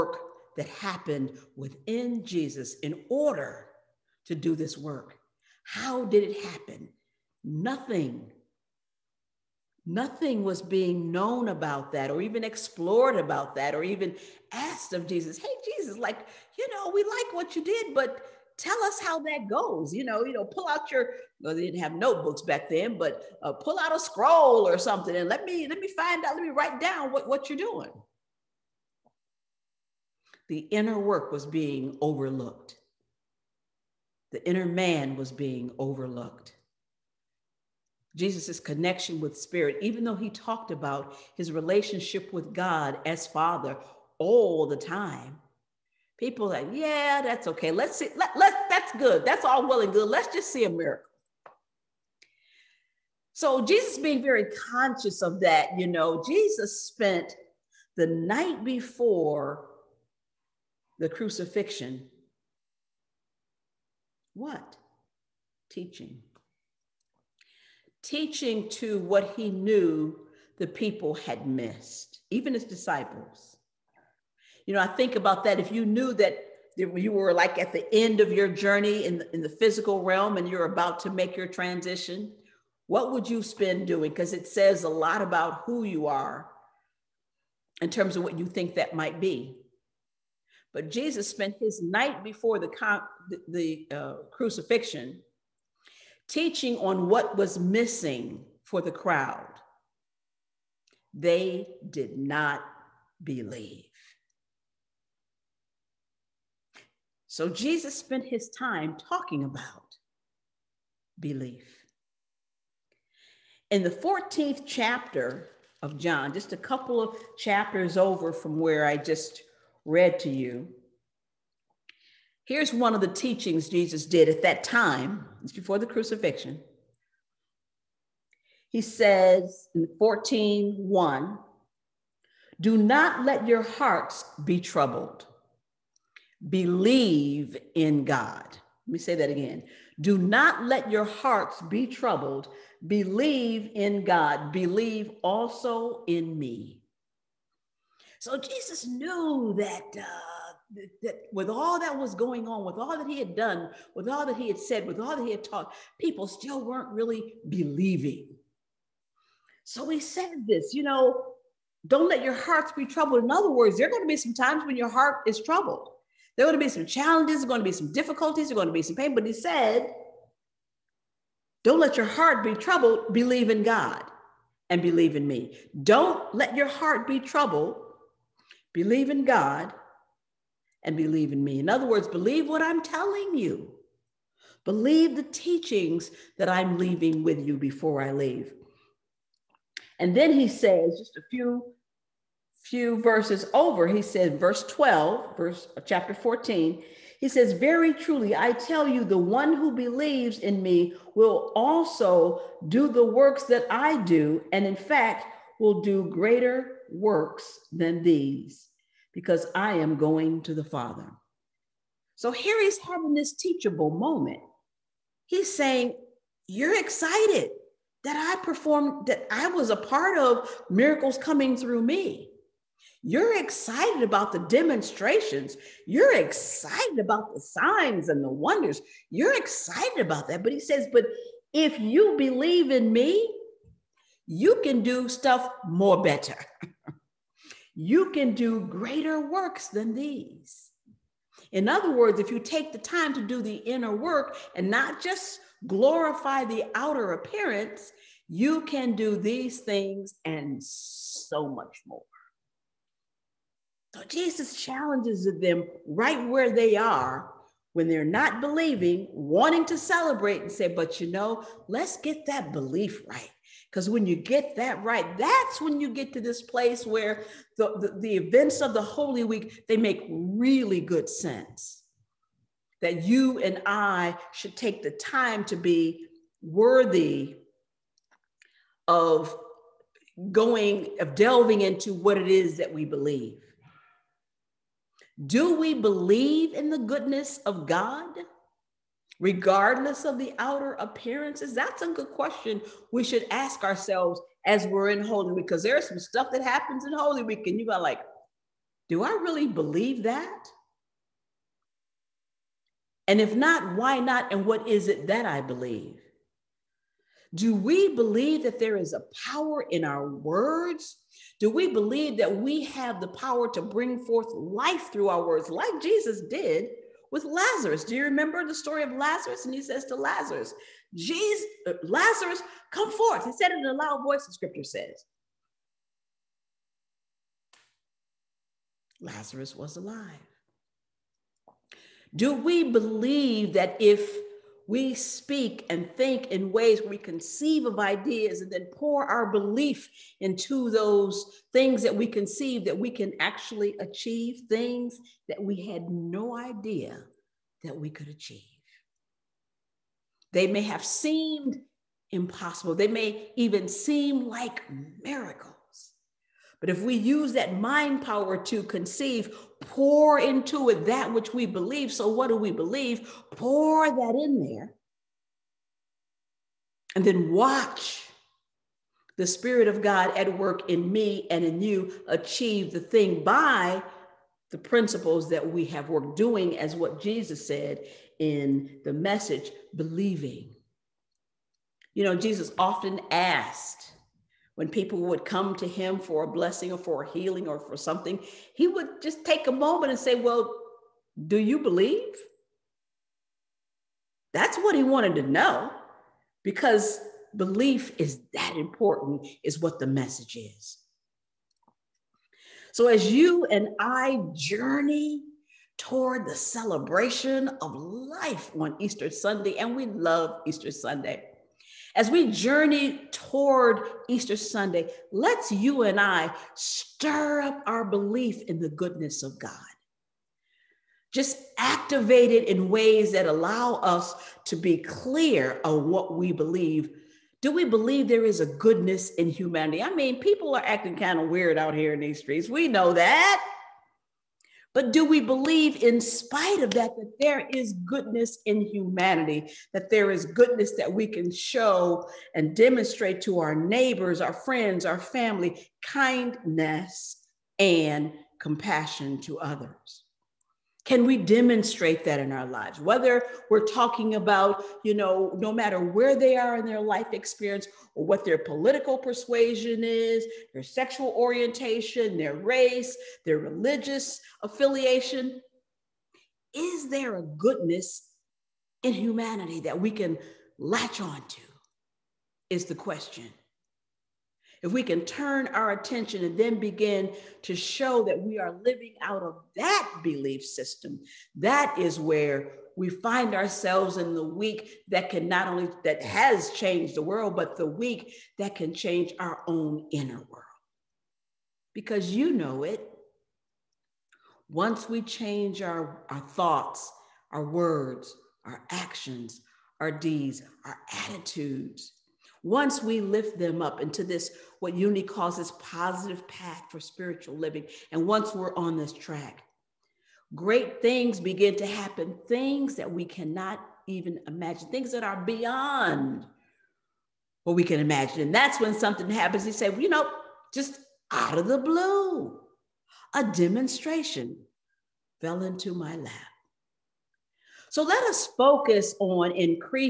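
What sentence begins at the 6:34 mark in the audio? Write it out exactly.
That's what he wanted to know because belief is that important, is what the message is.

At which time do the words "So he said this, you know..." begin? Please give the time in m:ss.
2:39.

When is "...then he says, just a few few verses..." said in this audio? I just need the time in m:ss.
3:10.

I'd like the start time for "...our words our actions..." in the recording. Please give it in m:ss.
8:17.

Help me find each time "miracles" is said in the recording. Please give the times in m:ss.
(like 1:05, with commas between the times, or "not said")
0:50, 3:40, 5:55.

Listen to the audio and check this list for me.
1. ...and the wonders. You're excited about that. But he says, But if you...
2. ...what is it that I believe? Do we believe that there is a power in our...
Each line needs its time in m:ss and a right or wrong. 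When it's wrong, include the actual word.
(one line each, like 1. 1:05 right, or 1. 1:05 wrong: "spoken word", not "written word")
1. 3:48 right
2. 5:04 right.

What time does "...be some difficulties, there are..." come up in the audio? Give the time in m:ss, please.
2:47.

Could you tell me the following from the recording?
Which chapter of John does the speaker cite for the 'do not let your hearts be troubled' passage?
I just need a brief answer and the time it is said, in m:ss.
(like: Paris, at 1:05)
14th chapter, at 1:53.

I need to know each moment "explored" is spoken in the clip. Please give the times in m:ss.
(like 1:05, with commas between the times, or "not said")
0:12.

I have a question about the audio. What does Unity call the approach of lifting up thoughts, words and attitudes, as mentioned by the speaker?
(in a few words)
positive path for spiritual living.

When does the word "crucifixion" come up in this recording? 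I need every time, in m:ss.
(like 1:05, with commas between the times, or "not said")
1:01, 1:34, 2:05.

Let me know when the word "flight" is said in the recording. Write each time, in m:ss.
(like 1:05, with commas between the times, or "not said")
not said.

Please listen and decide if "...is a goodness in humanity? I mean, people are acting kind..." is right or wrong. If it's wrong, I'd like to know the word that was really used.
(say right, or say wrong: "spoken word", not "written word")
right.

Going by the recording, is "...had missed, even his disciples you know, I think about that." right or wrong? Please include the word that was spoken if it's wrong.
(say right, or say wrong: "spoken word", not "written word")
right.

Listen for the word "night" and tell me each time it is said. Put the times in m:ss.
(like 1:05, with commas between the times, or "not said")
0:58, 1:31.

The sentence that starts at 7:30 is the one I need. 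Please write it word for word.
Can we demonstrate that in our lives?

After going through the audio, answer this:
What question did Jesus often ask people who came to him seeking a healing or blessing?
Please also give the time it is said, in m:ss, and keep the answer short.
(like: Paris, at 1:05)
Do you believe?, at 6:31.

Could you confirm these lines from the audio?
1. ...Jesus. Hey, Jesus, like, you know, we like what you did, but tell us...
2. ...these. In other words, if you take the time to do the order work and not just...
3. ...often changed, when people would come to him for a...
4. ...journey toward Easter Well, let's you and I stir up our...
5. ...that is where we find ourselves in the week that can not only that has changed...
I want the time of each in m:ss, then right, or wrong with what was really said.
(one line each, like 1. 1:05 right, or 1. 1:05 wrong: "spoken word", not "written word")
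1. 0:15 right
2. 3:59 wrong: "inner", not "order"
3. 6:22 wrong: "asked", not "changed"
4. 6:52 wrong: "Sunday", not "Well"
5. 8:01 right.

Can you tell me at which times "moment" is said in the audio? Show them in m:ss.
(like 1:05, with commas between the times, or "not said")
3:33, 6:29.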